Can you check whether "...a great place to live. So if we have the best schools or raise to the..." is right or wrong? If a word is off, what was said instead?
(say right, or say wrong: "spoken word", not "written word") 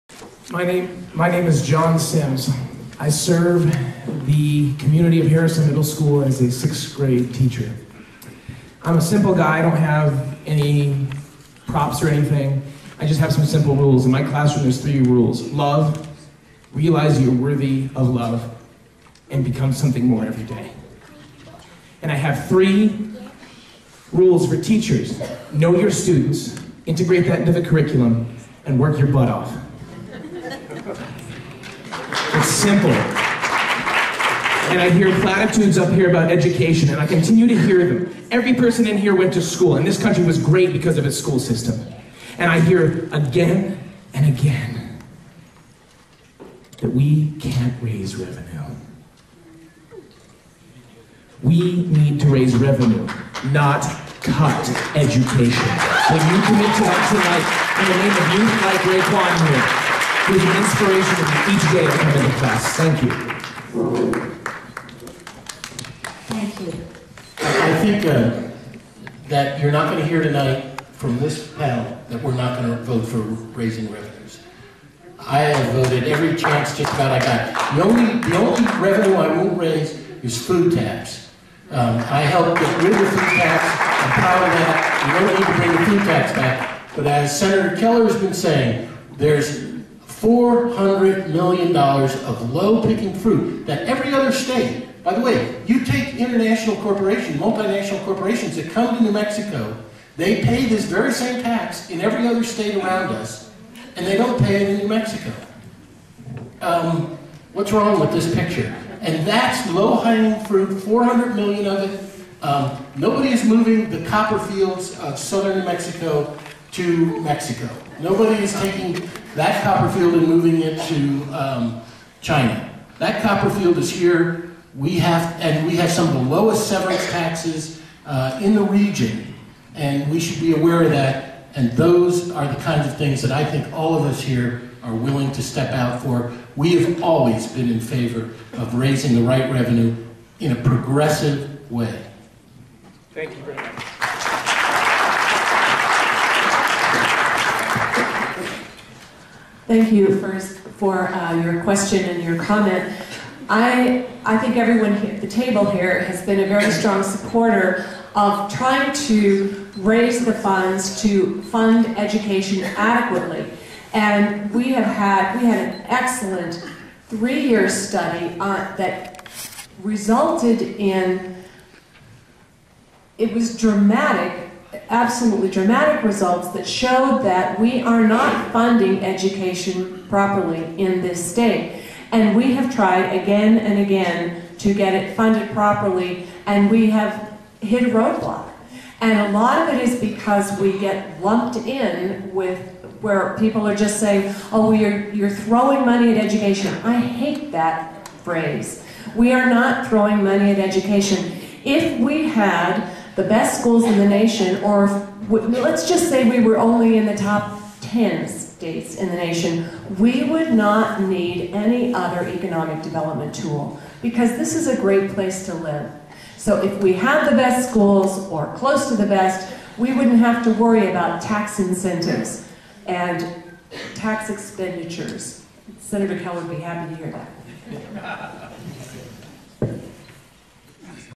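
wrong: "close", not "raise".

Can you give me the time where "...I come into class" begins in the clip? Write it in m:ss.
1:03.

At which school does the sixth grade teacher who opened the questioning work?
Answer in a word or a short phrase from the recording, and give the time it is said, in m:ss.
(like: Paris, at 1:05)
Harrison Middle School, at 0:05.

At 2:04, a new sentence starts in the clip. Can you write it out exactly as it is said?
We have, and we have some of the lowest severance taxes uh, in the region, and we should be aware of that.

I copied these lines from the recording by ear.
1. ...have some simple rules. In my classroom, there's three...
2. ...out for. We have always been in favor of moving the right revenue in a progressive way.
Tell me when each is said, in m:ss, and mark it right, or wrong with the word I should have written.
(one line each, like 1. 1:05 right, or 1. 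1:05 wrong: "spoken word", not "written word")
1. 0:13 right
2. 2:15 wrong: "raising", not "moving".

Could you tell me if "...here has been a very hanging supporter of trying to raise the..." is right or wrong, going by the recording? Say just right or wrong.
wrong.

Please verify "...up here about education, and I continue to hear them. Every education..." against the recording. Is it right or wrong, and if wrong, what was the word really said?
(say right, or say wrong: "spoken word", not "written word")
wrong: "person", not "education".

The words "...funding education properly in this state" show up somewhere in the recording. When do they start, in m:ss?
2:58.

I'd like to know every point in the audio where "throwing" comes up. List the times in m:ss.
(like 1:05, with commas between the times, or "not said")
3:15, 3:19.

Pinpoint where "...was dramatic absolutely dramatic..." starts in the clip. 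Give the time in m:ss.
2:53.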